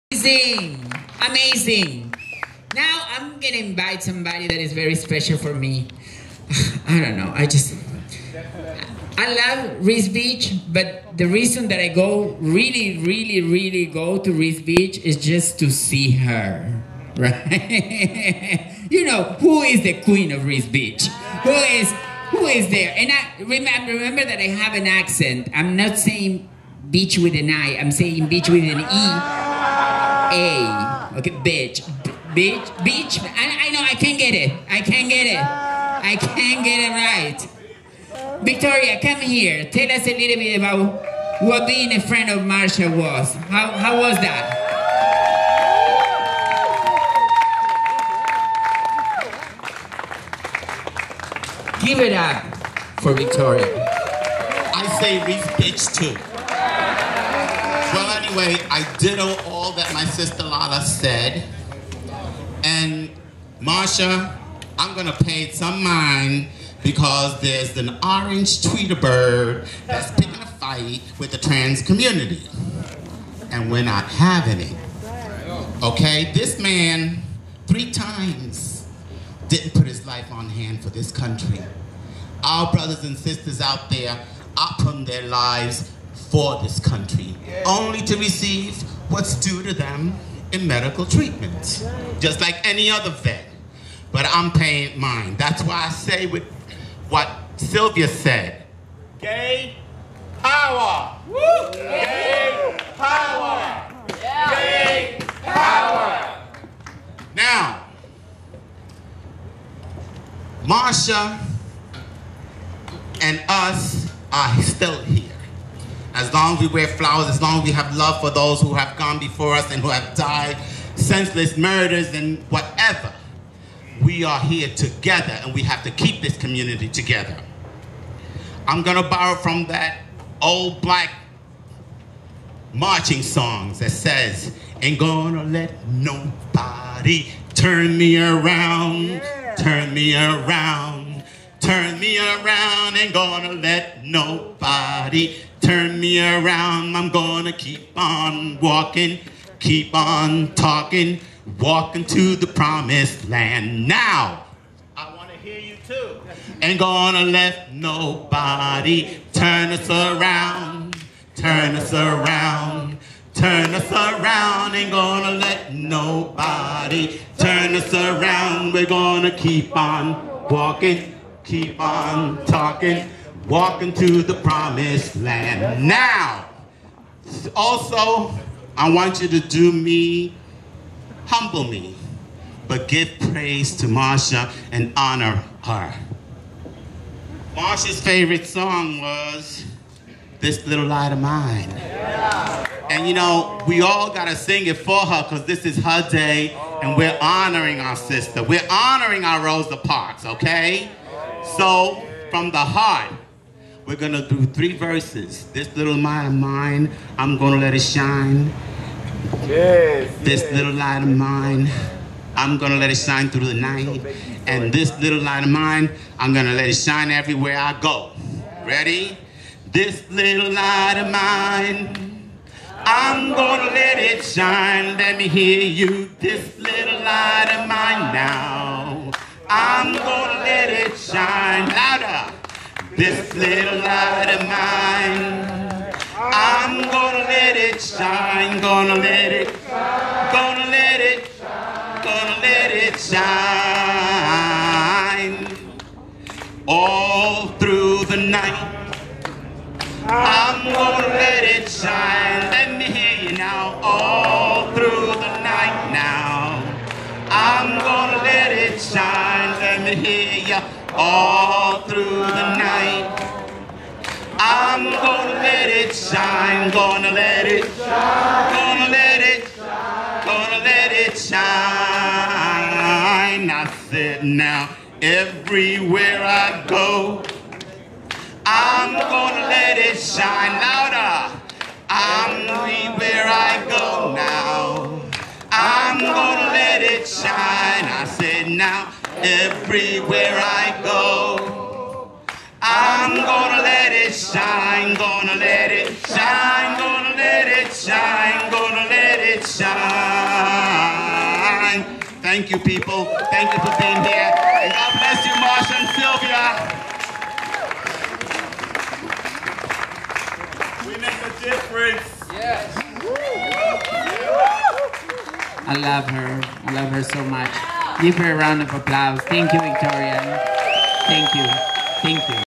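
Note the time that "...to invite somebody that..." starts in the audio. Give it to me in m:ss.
0:03.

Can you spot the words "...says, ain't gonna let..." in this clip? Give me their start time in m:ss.
2:13.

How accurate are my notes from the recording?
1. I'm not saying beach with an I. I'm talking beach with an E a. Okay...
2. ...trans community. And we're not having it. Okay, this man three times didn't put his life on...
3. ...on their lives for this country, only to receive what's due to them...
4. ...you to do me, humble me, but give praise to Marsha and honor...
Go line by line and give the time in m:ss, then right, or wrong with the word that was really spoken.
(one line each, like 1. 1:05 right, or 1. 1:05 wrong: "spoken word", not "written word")
1. 0:25 wrong: "saying", not "talking"
2. 1:11 right
3. 1:24 right
4. 2:59 right.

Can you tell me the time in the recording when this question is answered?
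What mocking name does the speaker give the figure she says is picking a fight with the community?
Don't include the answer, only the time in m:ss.
1:08.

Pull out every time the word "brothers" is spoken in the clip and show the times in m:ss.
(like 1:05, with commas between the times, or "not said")
1:22.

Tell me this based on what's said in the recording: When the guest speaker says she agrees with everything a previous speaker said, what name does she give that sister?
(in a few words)
Lala.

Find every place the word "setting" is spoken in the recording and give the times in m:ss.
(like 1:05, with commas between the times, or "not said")
not said.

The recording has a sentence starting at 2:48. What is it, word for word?
We're gonna keep on walking, keep on talking walking to the promised land.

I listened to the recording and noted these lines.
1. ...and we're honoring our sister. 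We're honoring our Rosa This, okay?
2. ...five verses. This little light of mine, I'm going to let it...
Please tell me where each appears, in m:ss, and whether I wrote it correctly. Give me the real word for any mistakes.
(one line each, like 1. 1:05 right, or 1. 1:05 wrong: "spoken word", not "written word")
1. 3:16 wrong: "Parks", not "This"
2. 3:24 wrong: "three", not "five".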